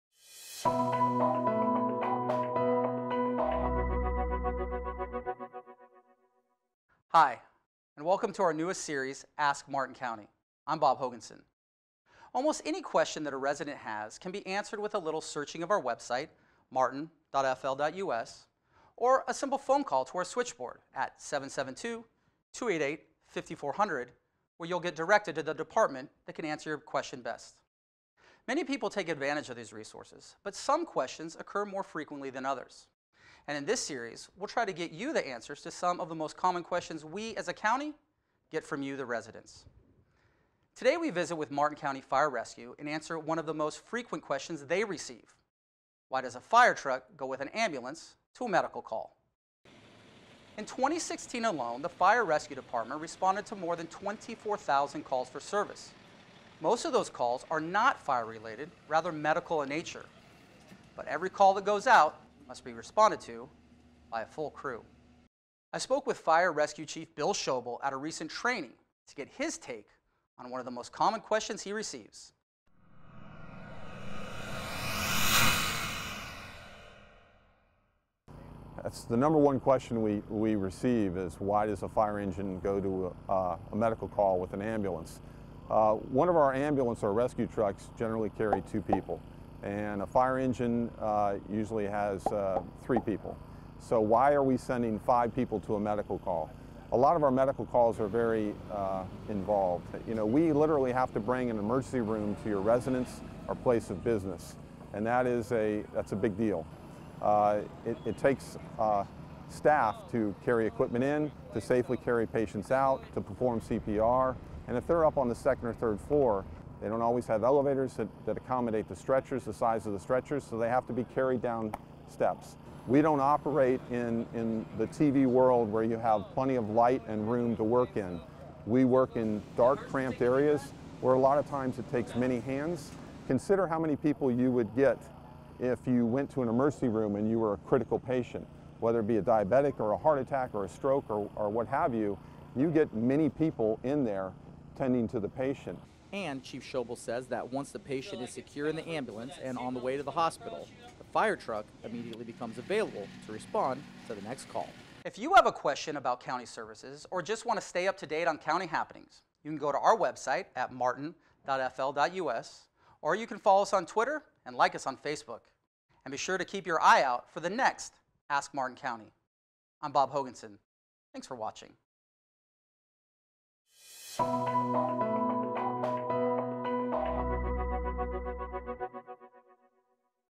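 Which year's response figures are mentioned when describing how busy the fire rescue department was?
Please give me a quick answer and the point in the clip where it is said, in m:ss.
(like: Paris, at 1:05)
2016, at 0:50.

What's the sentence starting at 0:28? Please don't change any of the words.
Many people take advantage of these resources, but some questions occur more frequently than others.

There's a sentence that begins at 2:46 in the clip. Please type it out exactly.
And be sure to keep your eye out for the next Ask Martin County.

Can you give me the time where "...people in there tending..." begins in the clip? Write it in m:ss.
2:23.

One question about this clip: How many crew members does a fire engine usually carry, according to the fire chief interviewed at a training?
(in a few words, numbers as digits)
3.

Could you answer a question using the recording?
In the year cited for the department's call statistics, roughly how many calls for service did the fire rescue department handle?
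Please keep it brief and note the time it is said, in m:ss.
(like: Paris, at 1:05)
more than 24,000, at 0:53.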